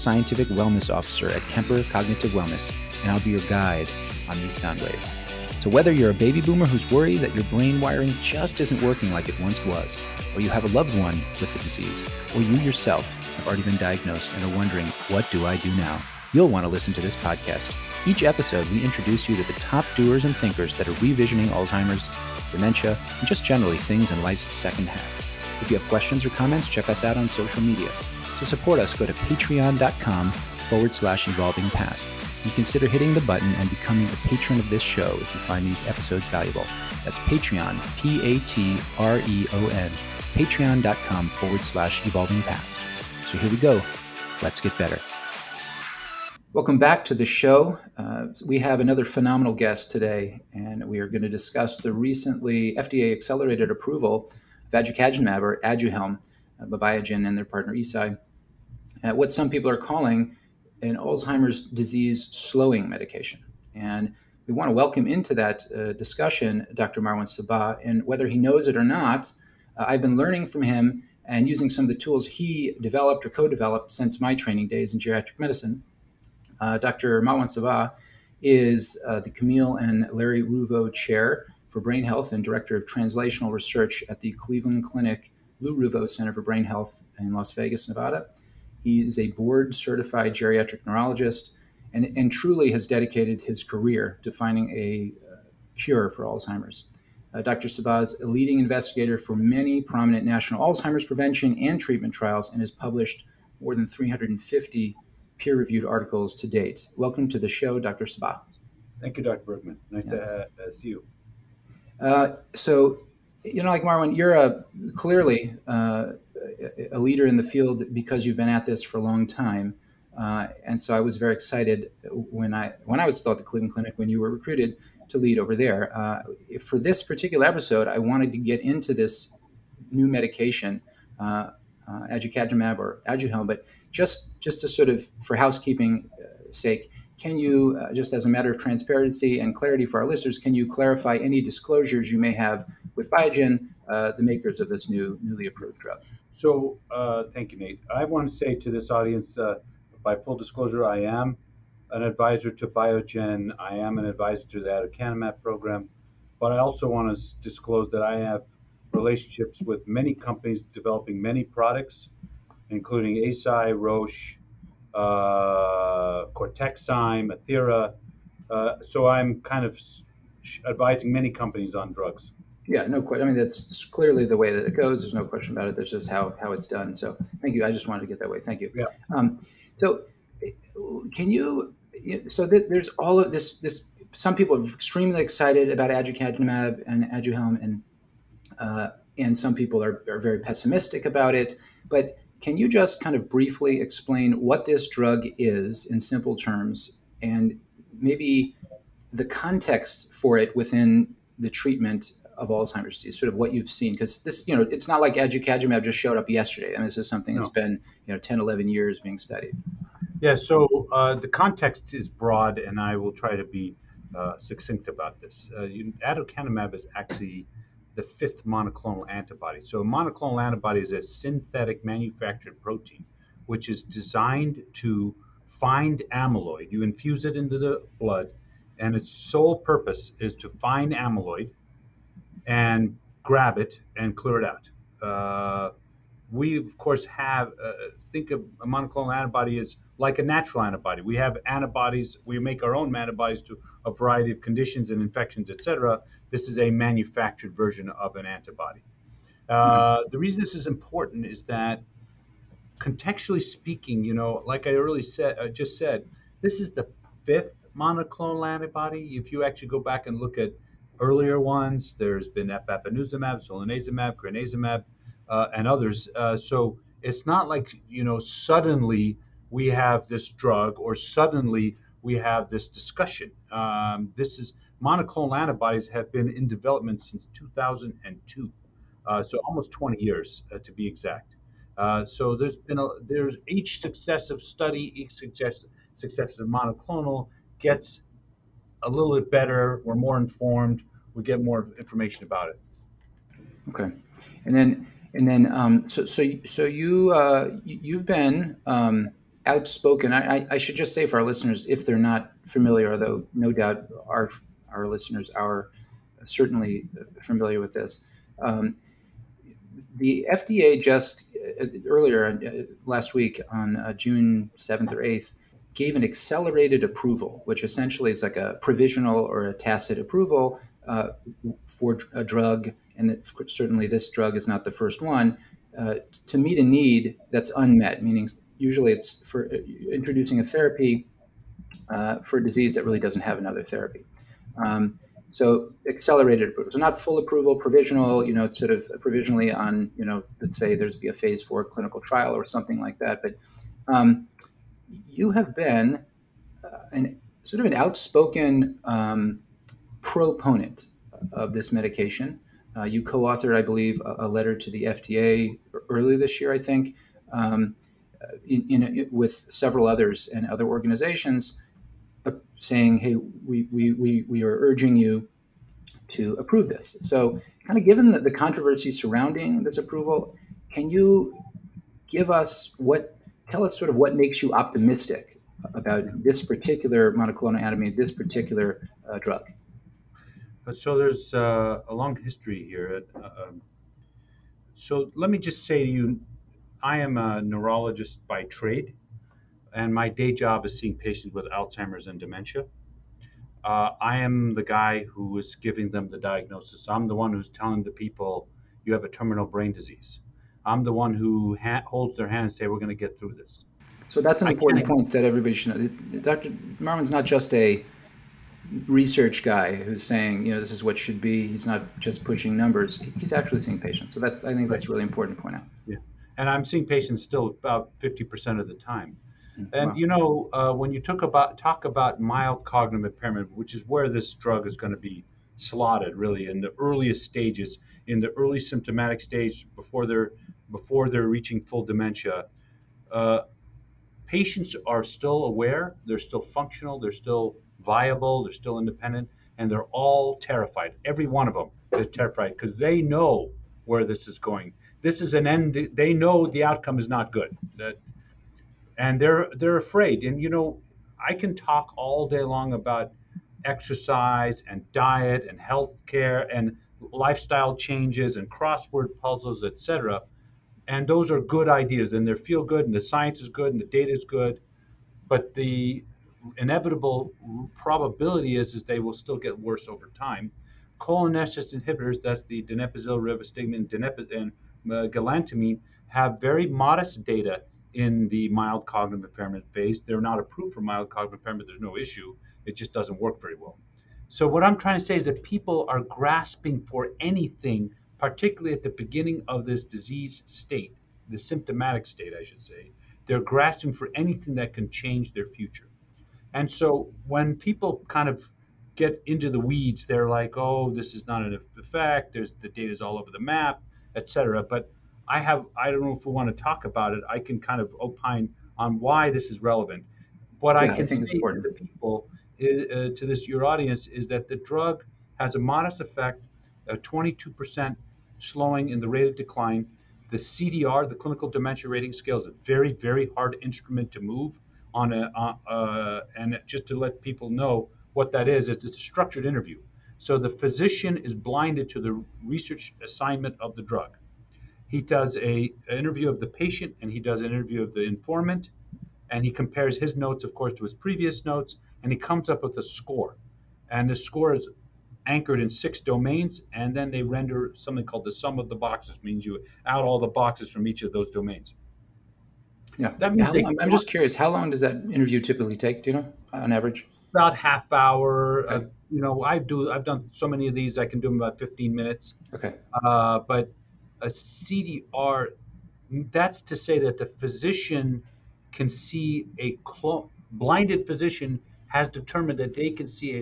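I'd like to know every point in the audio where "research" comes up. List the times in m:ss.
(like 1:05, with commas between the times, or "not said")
1:23, 6:48, 8:52.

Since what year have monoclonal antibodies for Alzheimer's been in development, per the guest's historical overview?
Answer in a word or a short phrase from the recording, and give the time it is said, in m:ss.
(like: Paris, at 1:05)
2002, at 4:37.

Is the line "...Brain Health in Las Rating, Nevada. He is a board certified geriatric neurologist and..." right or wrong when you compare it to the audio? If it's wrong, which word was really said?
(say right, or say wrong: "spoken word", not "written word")
wrong: "Vegas", not "Rating".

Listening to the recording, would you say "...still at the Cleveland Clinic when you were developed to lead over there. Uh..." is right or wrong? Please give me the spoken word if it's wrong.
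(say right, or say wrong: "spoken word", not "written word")
wrong: "recruited", not "developed".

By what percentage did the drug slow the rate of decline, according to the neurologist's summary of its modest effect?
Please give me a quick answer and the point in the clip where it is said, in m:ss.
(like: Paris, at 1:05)
22%, at 8:36.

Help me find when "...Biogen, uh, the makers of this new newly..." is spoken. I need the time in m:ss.
2:23.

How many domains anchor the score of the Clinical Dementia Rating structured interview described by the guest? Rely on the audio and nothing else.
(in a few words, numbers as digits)
six.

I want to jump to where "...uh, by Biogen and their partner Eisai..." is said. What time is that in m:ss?
0:56.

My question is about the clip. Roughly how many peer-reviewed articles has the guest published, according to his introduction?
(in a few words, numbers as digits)
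350.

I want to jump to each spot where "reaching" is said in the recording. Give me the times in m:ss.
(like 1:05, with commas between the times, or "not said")
7:11.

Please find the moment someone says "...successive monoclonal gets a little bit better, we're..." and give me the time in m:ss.
4:45.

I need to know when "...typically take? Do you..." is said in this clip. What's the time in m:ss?
9:15.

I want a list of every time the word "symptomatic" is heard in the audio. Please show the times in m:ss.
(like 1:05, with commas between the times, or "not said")
7:08, 8:11.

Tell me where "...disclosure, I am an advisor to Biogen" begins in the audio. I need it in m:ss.
2:30.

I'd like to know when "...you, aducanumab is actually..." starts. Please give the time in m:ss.
3:35.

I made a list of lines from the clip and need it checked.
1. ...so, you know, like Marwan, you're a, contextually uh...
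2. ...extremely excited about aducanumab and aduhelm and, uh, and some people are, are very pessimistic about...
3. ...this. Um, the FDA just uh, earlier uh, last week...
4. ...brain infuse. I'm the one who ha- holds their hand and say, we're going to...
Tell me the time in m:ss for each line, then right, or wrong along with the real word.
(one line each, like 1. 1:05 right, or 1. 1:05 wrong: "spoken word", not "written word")
1. 1:52 wrong: "clearly", not "contextually"
2. 3:04 right
3. 5:07 right
4. 6:39 wrong: "disease", not "infuse".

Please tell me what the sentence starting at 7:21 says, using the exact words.
Every one of them is terrified because they know where this is going.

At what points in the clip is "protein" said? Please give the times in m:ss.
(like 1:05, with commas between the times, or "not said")
3:42.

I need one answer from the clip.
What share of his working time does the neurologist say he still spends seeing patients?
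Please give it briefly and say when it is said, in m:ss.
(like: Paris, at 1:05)
50%, at 6:57.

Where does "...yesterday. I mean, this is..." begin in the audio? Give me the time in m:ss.
3:26.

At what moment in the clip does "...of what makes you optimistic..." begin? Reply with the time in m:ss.
6:13.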